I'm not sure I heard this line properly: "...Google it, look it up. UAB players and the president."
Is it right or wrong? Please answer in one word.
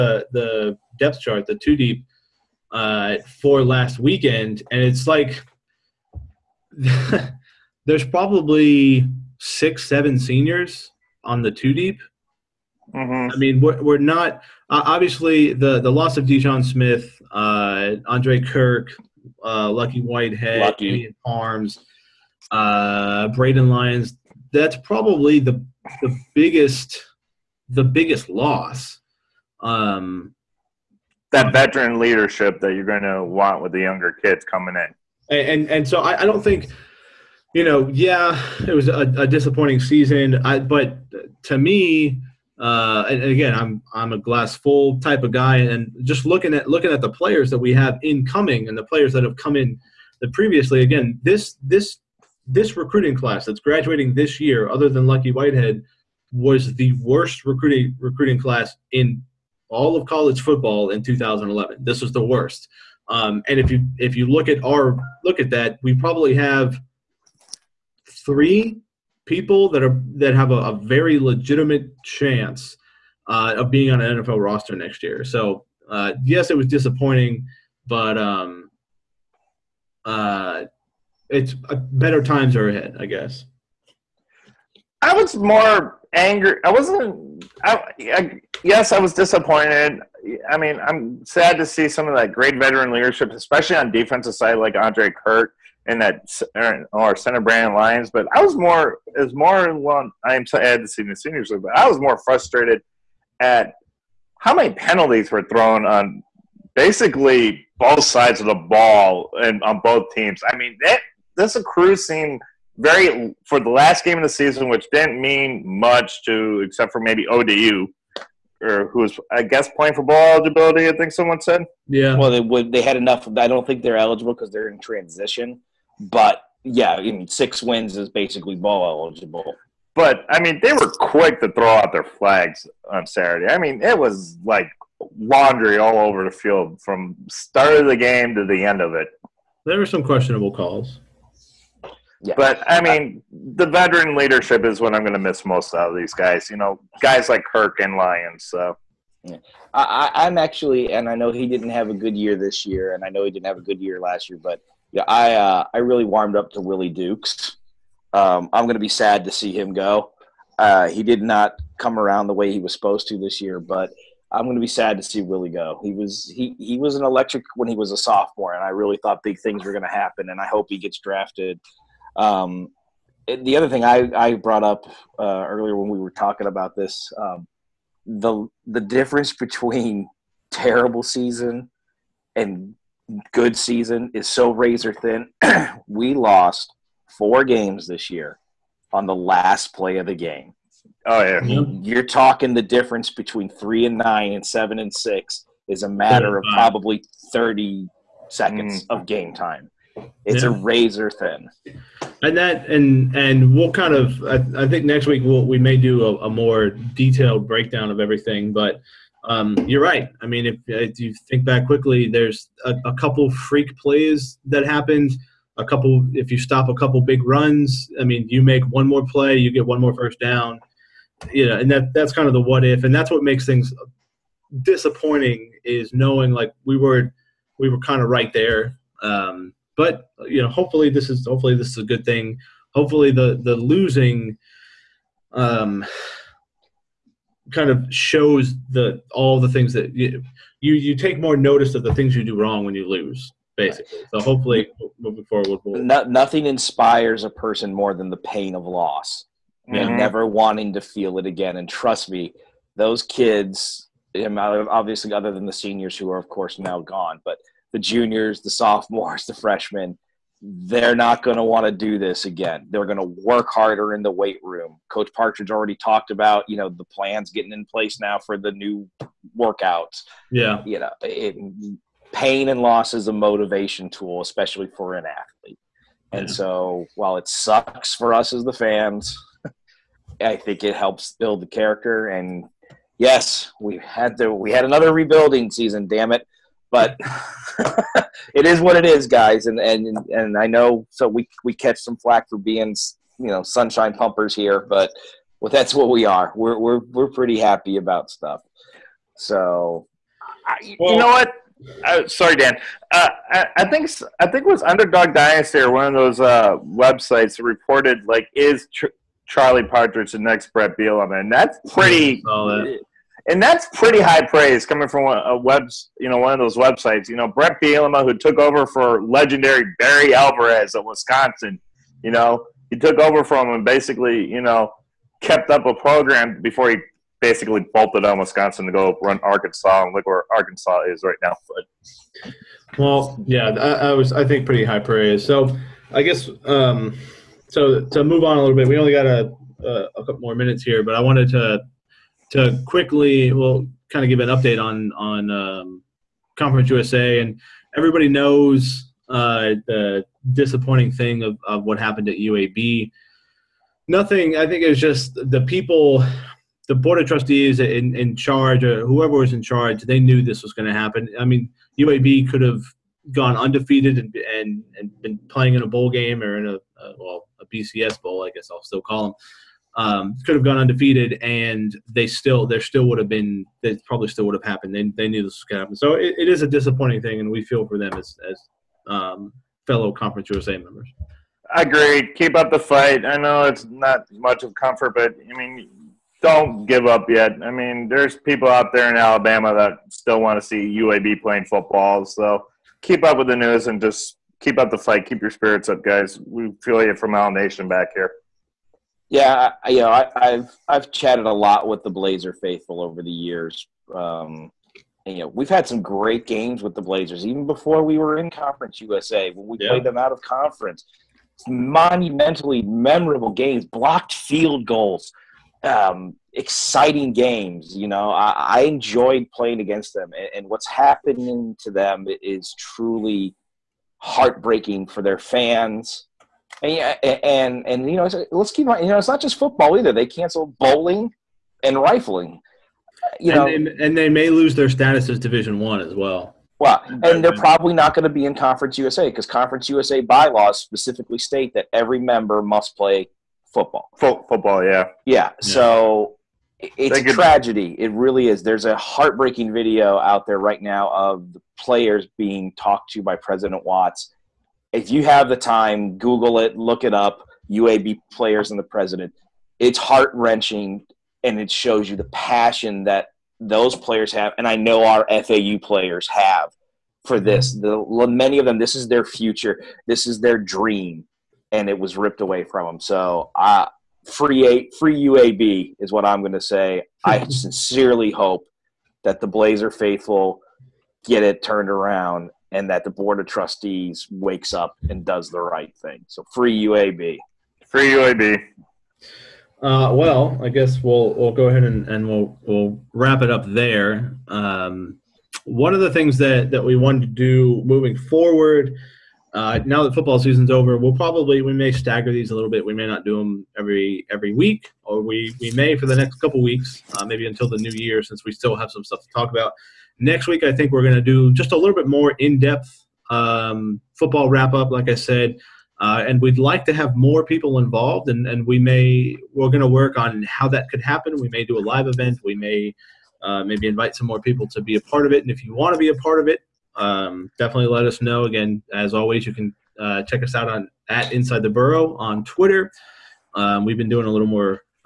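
right.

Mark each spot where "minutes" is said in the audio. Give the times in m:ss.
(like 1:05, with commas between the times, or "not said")
5:40.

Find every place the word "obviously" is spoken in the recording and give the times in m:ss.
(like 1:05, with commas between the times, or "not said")
0:14, 4:14.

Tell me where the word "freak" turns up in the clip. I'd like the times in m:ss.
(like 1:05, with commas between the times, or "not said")
3:33.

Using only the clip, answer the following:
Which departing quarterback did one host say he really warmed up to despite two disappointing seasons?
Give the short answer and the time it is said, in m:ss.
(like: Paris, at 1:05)
Willie Dukes, at 2:36.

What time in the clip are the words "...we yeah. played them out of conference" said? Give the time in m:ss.
6:49.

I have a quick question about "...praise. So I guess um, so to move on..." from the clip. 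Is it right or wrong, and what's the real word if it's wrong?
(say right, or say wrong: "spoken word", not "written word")
right.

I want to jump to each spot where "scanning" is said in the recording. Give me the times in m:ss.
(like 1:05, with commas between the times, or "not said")
not said.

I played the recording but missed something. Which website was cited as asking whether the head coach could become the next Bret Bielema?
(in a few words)
Underdog Dynasty.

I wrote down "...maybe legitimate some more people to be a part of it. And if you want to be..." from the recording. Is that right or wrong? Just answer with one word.
wrong.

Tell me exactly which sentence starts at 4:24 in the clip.
Coach Partridge already talked about, you know, the plans getting in place now for the new workouts.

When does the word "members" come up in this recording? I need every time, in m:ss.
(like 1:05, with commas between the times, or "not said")
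6:20, 7:21.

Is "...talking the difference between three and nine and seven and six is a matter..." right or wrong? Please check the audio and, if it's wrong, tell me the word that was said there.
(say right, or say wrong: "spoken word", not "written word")
right.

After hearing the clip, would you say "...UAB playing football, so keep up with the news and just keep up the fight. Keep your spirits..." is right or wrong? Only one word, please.
right.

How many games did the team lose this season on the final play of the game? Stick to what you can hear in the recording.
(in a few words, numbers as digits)
4.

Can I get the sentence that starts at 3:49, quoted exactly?
Um, but you know, hopefully this is hopefully this is a good thing.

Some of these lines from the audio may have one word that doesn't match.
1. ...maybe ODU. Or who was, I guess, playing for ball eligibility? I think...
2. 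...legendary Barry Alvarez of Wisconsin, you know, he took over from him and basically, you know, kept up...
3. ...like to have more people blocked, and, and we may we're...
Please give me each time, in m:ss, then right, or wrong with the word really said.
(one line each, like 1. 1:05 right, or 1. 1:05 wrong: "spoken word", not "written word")
1. 1:56 right
2. 5:19 right
3. 8:36 wrong: "involved", not "blocked".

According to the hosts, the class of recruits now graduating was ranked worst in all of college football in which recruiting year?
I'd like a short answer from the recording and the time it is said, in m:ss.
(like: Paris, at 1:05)
2011, at 1:01.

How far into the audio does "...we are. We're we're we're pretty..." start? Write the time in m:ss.
4:55.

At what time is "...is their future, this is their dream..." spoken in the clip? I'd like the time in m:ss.
7:48.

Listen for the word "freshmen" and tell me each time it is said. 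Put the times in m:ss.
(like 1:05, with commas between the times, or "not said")
4:19.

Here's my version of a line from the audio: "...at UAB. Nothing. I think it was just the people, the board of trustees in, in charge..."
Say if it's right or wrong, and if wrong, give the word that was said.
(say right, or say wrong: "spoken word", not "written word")
right.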